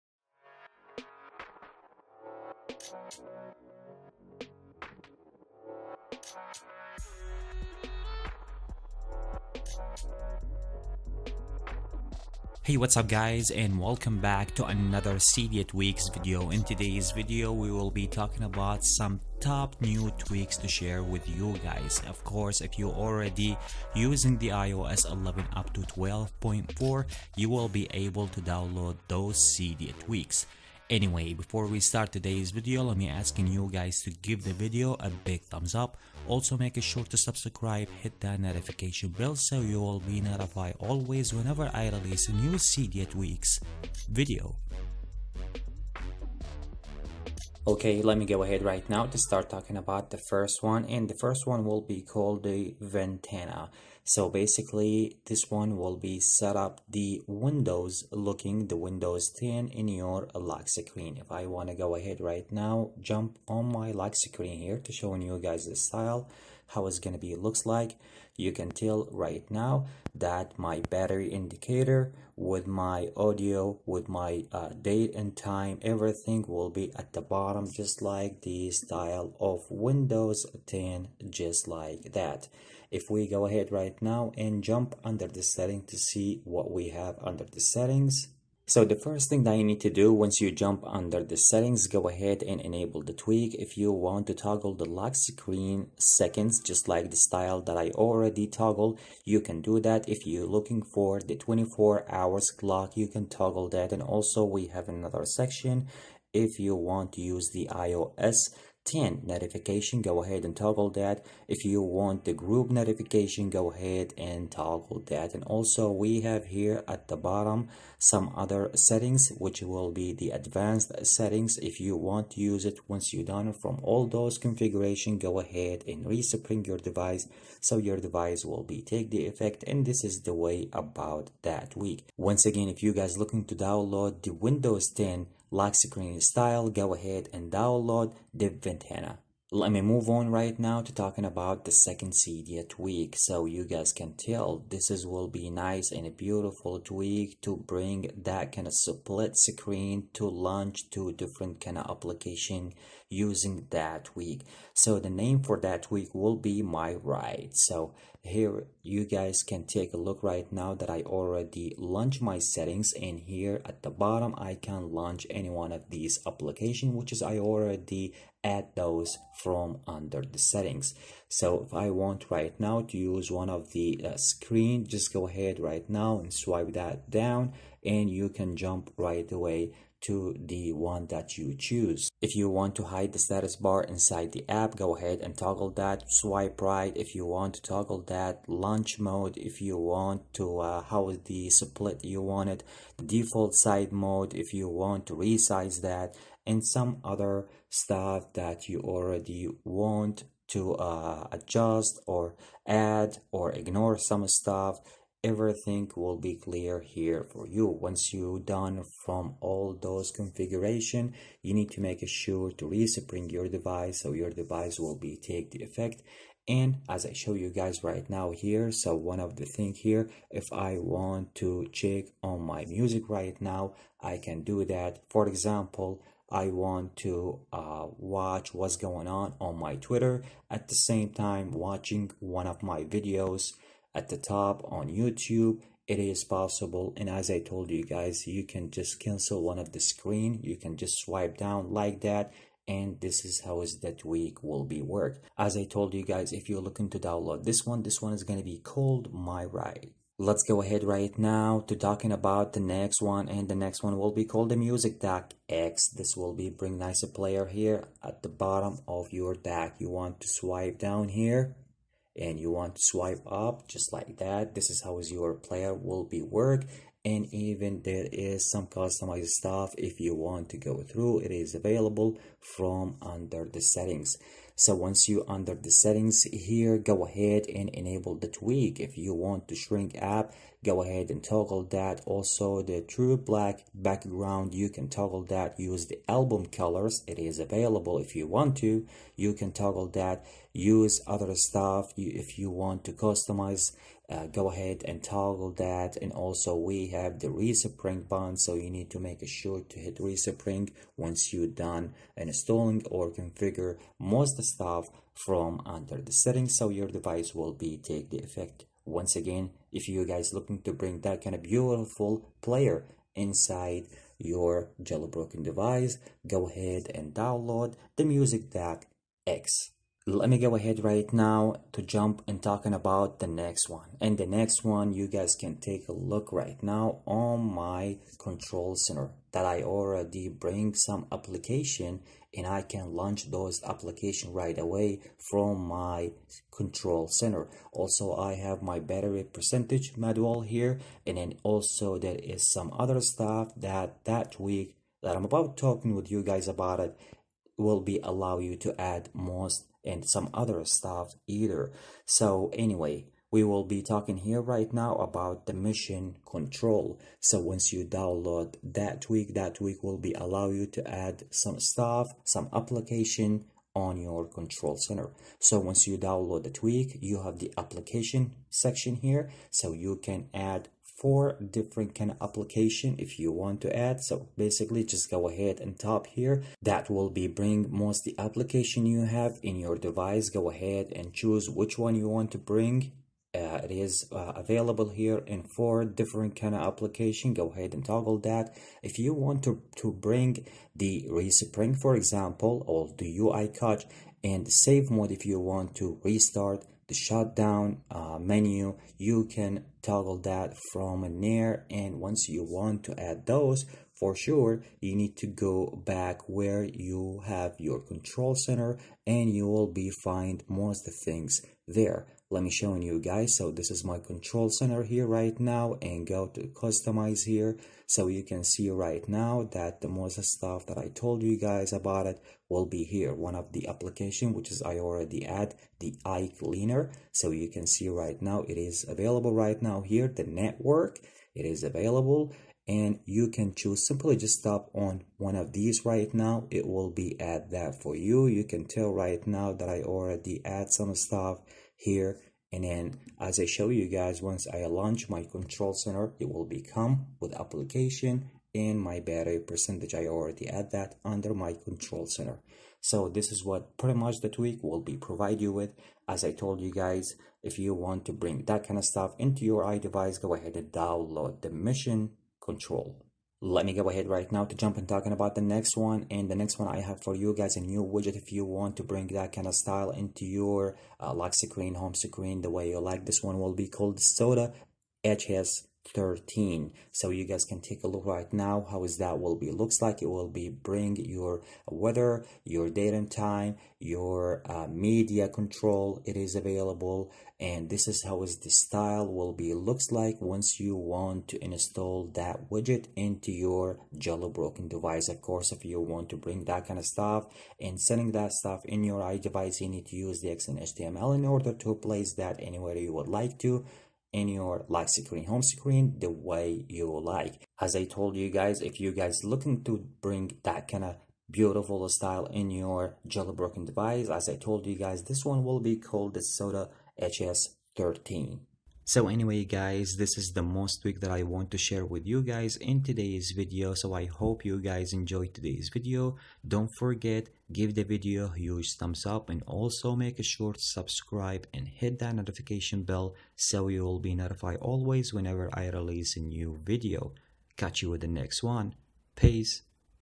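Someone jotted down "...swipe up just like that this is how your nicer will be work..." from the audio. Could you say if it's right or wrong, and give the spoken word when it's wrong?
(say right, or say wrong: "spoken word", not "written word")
wrong: "player", not "nicer".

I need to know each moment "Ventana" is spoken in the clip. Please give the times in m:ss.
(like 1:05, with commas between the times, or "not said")
0:52, 2:18.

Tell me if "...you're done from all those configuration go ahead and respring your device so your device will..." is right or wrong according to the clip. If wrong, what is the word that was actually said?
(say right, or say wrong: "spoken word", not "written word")
right.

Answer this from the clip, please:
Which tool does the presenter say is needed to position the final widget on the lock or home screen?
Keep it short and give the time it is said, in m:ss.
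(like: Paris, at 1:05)
XenHTML, at 8:20.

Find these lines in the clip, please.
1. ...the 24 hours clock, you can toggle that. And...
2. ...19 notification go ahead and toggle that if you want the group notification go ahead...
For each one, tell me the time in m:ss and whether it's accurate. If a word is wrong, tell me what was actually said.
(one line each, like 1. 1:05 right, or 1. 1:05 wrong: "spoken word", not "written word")
1. 1:41 right
2. 1:48 wrong: "10", not "19".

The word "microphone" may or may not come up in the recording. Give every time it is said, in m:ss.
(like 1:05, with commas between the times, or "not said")
not said.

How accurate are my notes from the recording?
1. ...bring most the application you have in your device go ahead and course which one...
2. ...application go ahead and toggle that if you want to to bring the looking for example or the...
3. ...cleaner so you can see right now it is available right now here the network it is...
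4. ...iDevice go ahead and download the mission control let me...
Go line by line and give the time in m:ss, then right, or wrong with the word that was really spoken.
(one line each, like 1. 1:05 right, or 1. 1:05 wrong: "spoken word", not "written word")
1. 6:17 wrong: "choose", not "course"
2. 6:26 wrong: "respring", not "looking"
3. 7:06 right
4. 7:39 right.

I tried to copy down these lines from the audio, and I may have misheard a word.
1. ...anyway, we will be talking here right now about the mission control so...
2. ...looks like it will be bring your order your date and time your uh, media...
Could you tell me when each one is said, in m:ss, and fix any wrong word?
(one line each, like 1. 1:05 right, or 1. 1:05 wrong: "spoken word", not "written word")
1. 5:52 right
2. 7:59 wrong: "weather", not "order".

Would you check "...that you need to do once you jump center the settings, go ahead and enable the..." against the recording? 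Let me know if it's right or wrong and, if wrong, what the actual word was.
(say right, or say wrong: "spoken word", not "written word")
wrong: "under", not "center".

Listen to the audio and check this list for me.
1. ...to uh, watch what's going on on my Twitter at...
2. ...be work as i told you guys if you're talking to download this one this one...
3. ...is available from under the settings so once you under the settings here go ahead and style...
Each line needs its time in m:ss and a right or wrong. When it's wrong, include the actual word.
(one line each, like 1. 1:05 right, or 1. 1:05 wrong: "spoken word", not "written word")
1. 3:47 right
2. 4:04 wrong: "looking", not "talking"
3. 4:31 wrong: "enable", not "style".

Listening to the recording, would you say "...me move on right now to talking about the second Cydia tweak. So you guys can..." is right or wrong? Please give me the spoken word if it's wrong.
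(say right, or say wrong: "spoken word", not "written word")
right.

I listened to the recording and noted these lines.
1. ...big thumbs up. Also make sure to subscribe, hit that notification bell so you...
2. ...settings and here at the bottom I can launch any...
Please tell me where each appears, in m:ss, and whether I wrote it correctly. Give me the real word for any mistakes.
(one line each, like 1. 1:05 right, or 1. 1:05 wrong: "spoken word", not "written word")
1. 0:35 right
2. 2:42 right.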